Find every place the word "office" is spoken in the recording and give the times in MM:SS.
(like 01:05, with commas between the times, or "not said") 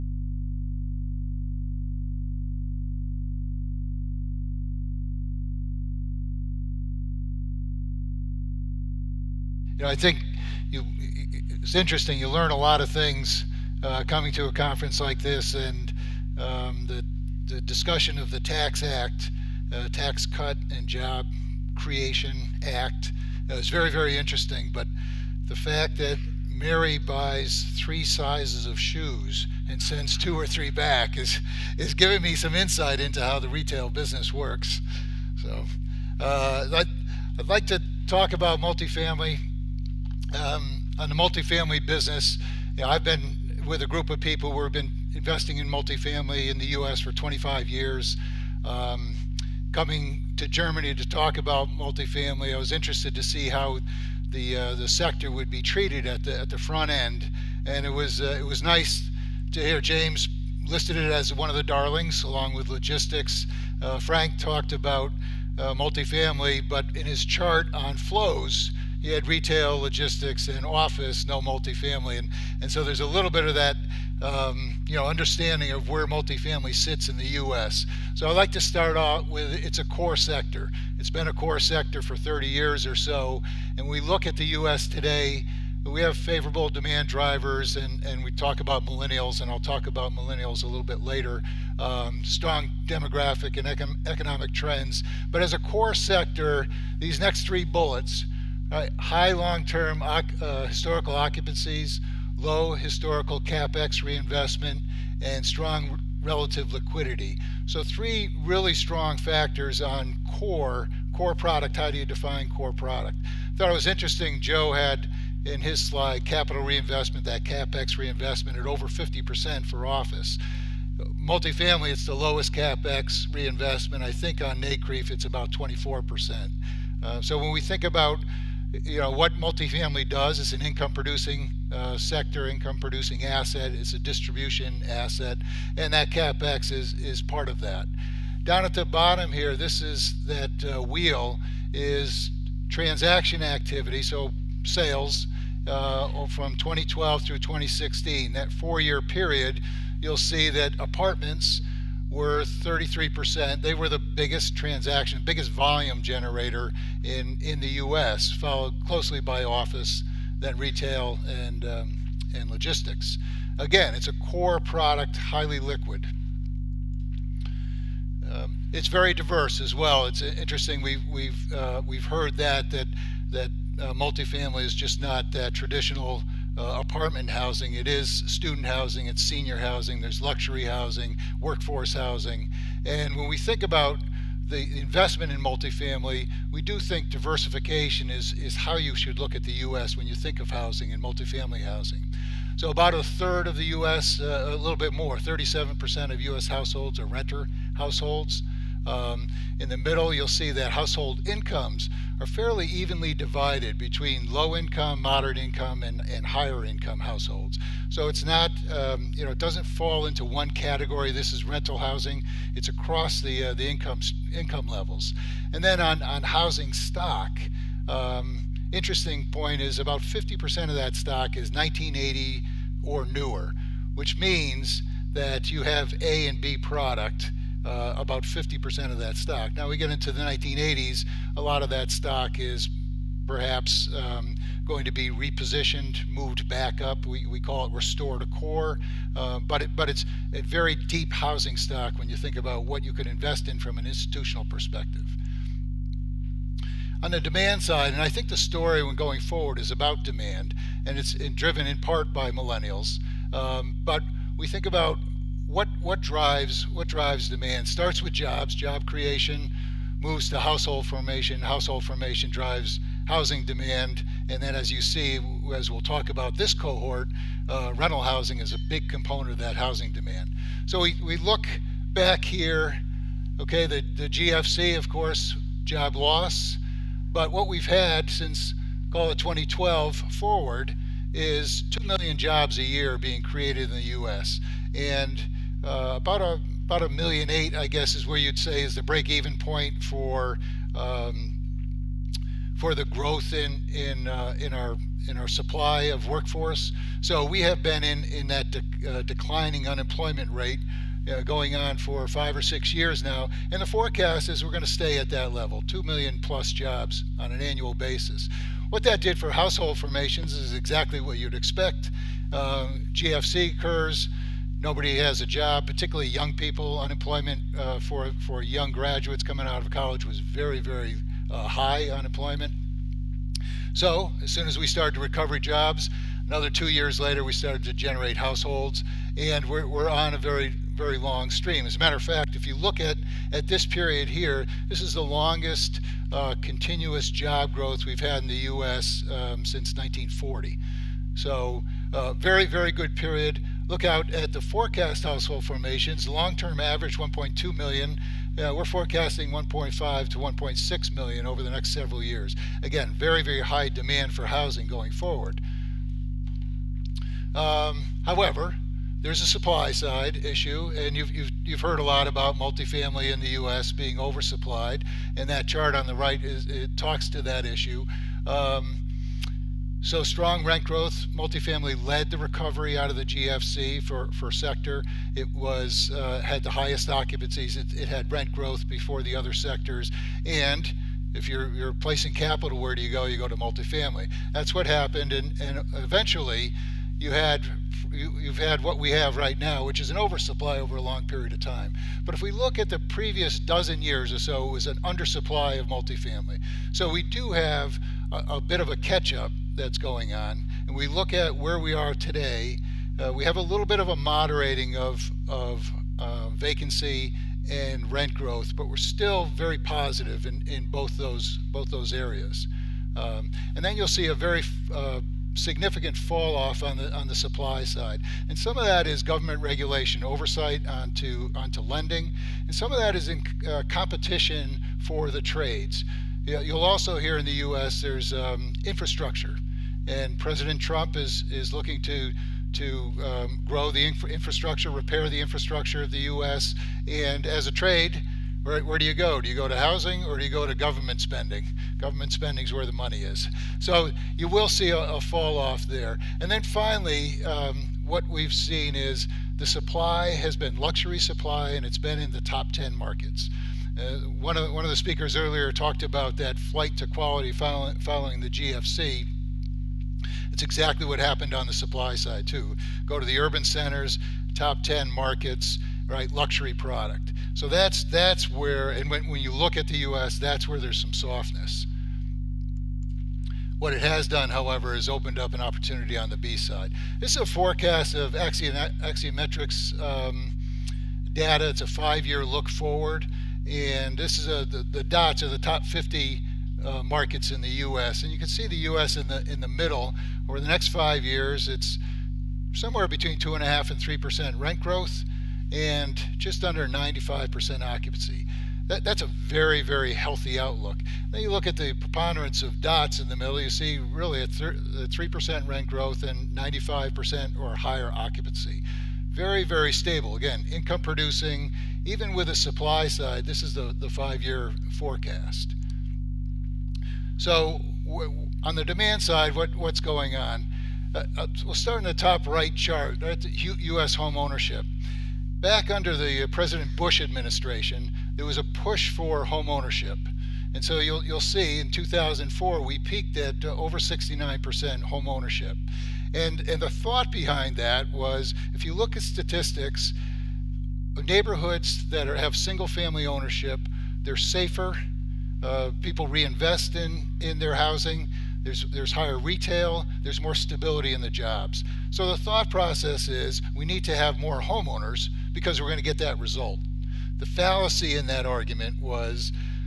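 01:10, 01:59, 02:39.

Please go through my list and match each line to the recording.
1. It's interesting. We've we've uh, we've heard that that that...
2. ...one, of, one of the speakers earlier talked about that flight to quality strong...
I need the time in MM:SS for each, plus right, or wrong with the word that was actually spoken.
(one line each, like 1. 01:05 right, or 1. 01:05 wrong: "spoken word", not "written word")
1. 02:50 right
2. 07:34 wrong: "following", not "strong".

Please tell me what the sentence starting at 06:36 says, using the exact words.
So we do have a, a bit of a catch up that's going on.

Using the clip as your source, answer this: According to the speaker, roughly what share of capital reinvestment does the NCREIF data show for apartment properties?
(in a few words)
24%.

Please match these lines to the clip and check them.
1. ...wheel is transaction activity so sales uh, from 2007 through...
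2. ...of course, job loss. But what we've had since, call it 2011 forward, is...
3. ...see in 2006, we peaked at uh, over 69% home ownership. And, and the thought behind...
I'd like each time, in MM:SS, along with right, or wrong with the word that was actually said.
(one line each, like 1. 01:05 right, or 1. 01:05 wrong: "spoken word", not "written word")
1. 02:20 wrong: "2012", not "2007"
2. 04:34 wrong: "2012", not "2011"
3. 08:51 wrong: "2004", not "2006".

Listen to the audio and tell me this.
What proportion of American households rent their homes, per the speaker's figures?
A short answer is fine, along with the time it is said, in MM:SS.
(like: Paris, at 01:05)
37%, at 03:15.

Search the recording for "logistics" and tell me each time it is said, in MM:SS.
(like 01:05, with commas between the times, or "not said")
01:02, 01:09, 02:42.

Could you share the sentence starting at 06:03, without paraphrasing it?
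being oversupplied, and that chart on the right is, it talks to that issue.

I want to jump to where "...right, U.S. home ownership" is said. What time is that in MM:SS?
08:43.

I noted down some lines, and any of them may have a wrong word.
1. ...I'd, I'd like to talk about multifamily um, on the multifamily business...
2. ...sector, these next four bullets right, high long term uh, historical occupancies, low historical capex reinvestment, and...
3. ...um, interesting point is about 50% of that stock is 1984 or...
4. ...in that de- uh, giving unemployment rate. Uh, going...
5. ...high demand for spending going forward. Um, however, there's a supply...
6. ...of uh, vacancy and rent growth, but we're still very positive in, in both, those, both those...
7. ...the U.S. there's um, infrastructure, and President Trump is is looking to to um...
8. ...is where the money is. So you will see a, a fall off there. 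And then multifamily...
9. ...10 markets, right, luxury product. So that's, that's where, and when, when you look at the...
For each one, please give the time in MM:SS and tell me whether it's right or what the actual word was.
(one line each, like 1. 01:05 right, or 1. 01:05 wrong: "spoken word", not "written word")
1. 00:36 right
2. 01:35 wrong: "three", not "four"
3. 03:37 wrong: "1980", not "1984"
4. 04:58 wrong: "declining", not "giving"
5. 05:53 wrong: "housing", not "spending"
6. 06:45 right
7. 07:07 right
8. 07:22 wrong: "finally", not "multifamily"
9. 07:44 right.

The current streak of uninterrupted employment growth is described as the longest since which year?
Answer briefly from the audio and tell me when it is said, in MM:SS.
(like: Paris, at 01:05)
1940, at 05:39.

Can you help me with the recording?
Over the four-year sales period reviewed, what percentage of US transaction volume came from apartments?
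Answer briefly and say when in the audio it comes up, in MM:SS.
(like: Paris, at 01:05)
33%, at 02:32.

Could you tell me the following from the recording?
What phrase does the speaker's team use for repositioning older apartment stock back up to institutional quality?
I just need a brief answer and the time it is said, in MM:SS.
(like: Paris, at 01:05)
restore to core, at 03:57.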